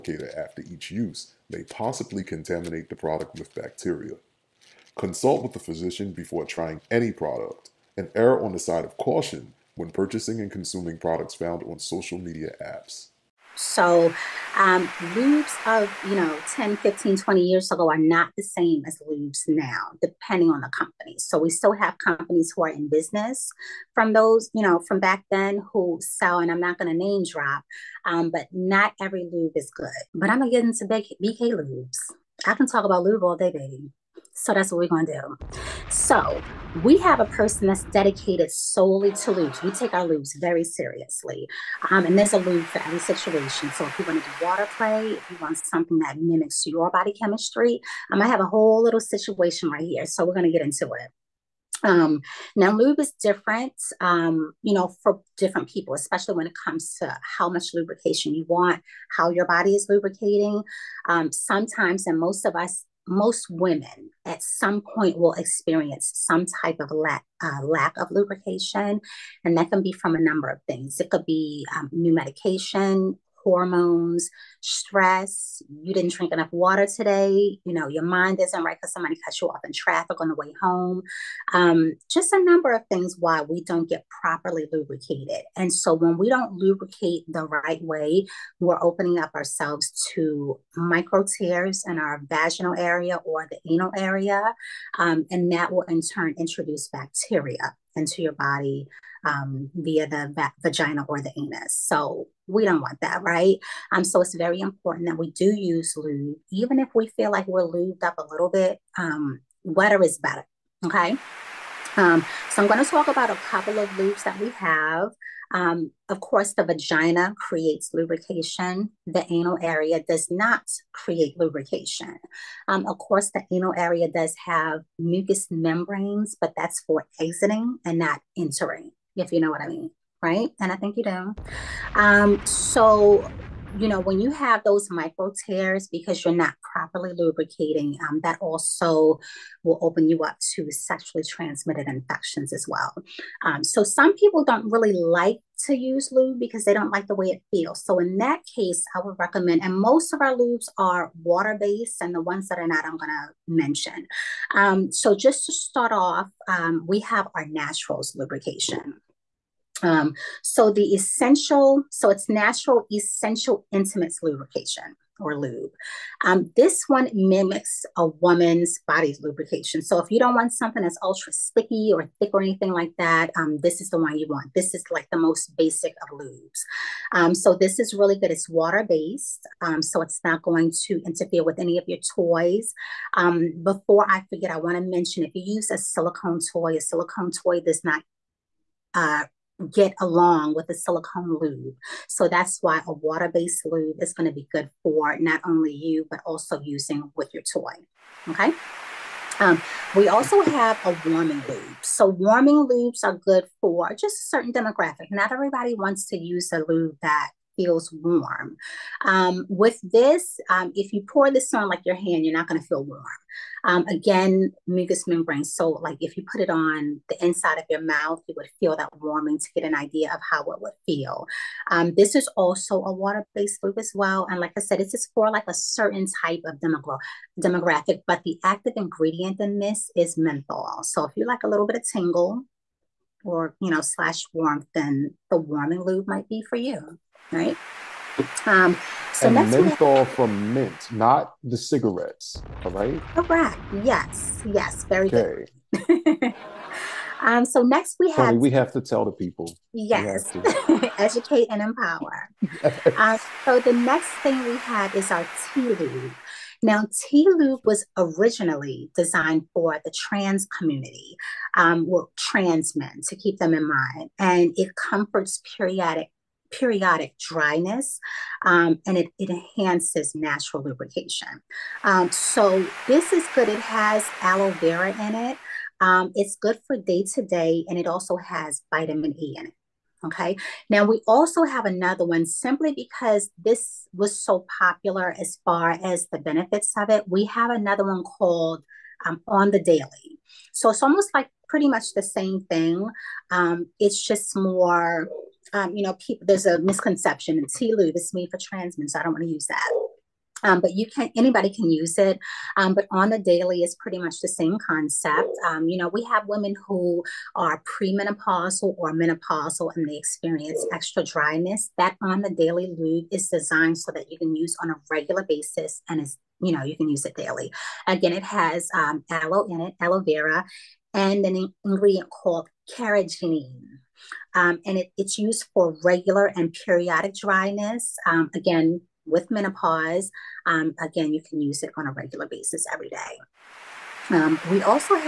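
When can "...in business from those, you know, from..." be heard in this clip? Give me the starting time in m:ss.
0:22.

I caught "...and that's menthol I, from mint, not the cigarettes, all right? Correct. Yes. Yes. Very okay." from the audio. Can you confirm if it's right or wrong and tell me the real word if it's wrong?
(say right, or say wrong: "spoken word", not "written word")
right.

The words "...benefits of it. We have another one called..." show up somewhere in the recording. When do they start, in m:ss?
4:46.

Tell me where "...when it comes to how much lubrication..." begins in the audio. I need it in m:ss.
0:56.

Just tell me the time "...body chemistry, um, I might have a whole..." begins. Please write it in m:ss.
0:46.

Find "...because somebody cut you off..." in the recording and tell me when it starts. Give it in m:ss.
1:18.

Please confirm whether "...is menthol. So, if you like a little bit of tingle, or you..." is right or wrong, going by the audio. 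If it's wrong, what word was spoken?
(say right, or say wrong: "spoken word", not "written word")
right.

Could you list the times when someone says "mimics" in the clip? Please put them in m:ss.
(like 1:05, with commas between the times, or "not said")
0:46, 2:47.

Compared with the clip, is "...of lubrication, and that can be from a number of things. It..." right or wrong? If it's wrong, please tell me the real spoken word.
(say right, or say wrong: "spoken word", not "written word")
right.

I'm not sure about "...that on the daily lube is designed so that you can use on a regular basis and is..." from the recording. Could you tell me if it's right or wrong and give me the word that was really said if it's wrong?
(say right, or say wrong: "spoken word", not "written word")
right.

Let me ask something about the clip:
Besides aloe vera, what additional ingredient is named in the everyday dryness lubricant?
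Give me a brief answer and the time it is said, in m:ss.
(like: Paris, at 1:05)
Carrageenan, at 5:22.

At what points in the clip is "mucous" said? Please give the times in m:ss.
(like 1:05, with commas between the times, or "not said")
2:04, 3:34.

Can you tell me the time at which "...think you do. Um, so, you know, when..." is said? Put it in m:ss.
2:10.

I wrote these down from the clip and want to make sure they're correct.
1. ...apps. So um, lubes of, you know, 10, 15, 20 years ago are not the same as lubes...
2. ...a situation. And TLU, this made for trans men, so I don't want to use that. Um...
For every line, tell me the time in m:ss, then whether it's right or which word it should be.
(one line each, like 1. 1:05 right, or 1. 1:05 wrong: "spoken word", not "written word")
1. 0:12 right
2. 4:56 wrong: "misconception", not "situation".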